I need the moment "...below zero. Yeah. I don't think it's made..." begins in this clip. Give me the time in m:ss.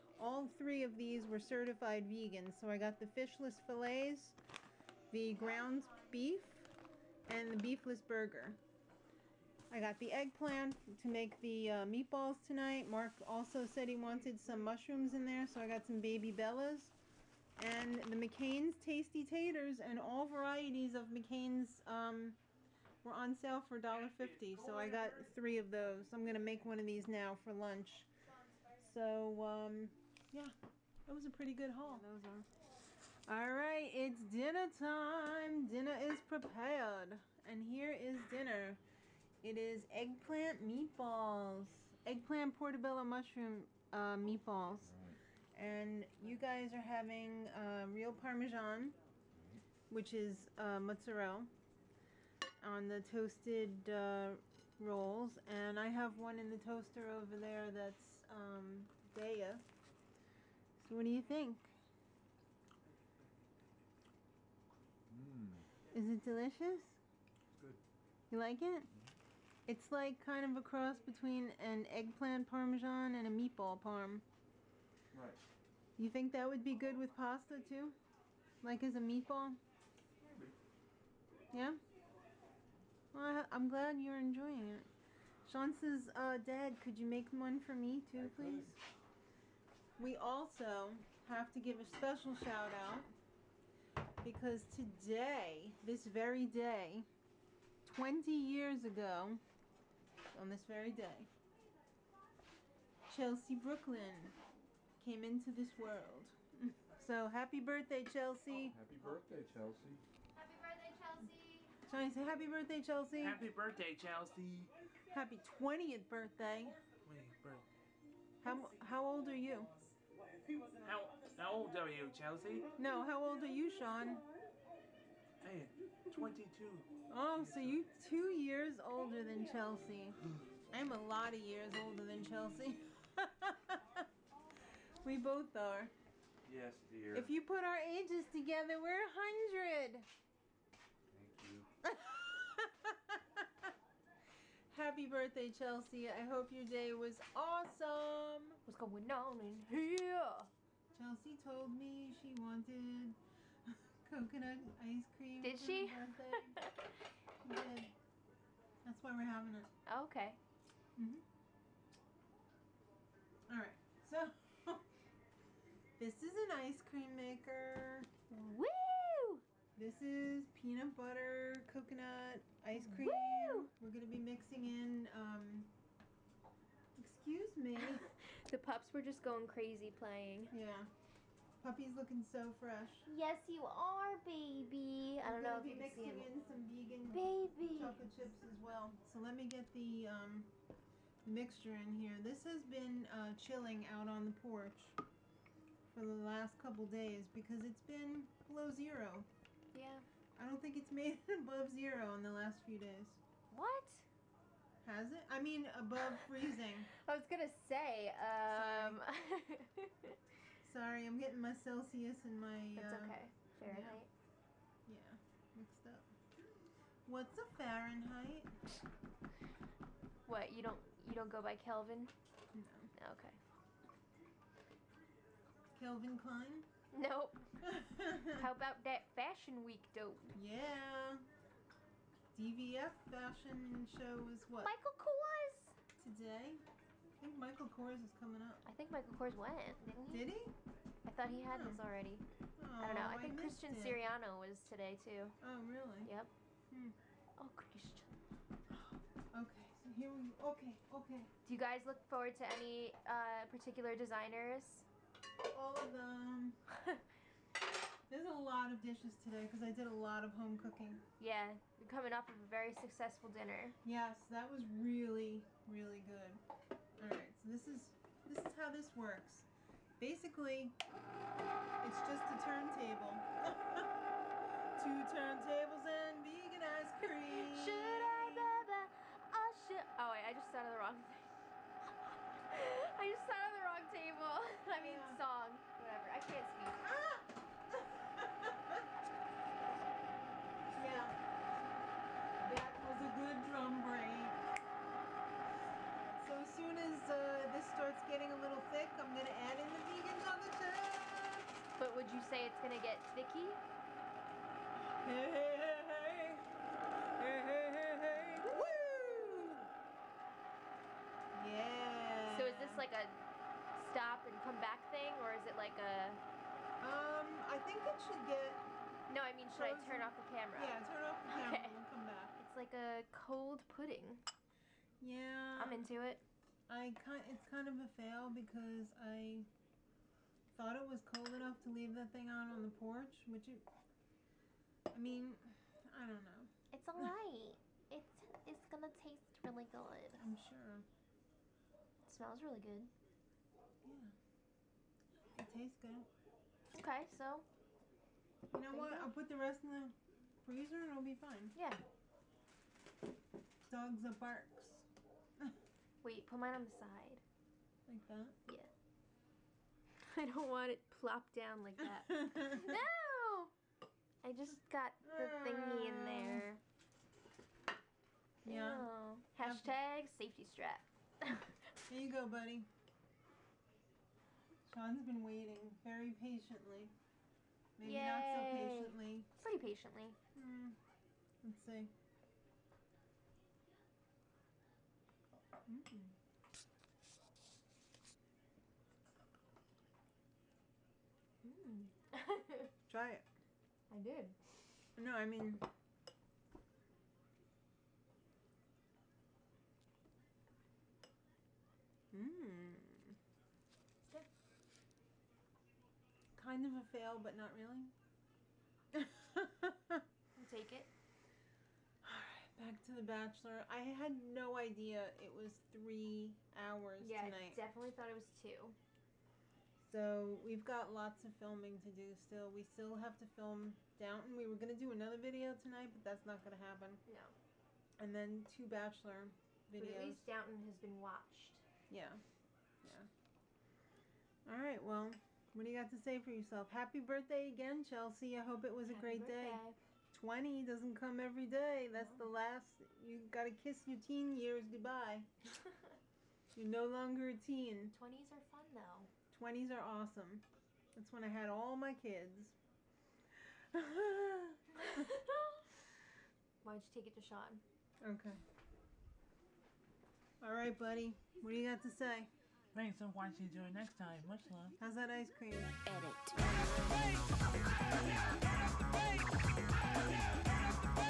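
3:18.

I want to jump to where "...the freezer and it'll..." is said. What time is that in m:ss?
5:49.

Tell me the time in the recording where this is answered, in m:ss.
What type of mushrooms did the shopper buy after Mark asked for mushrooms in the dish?
0:16.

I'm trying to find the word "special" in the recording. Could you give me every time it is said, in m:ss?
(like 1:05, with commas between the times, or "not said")
1:31.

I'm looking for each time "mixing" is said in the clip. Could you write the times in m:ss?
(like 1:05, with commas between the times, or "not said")
2:54, 3:06.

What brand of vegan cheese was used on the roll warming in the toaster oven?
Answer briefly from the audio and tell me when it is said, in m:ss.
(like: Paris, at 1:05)
Daiya, at 0:59.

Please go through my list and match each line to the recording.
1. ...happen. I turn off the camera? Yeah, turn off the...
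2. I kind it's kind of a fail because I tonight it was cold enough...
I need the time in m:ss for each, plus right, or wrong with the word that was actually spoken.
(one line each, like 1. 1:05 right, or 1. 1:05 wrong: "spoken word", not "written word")
1. 5:19 wrong: "frozen", not "happen"
2. 5:26 wrong: "thought", not "tonight".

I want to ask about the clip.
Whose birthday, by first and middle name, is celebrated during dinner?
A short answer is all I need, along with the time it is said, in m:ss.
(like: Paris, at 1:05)
Chelsea Brooklyn, at 1:43.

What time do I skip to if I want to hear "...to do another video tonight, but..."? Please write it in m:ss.
7:04.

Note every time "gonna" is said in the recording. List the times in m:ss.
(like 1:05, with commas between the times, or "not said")
3:27, 5:38.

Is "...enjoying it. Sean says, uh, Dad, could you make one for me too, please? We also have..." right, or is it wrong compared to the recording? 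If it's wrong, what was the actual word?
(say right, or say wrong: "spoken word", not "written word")
right.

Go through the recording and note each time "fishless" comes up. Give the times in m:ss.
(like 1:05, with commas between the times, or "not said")
0:03.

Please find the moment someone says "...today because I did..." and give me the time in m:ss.
4:19.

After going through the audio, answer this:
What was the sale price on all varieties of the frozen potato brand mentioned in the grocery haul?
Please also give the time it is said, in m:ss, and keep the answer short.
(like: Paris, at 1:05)
$1.50, at 0:23.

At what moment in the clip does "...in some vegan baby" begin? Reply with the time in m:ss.
3:06.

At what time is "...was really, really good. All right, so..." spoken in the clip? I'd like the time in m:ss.
4:24.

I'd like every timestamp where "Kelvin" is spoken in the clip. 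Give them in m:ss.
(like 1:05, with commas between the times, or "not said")
3:41, 3:45.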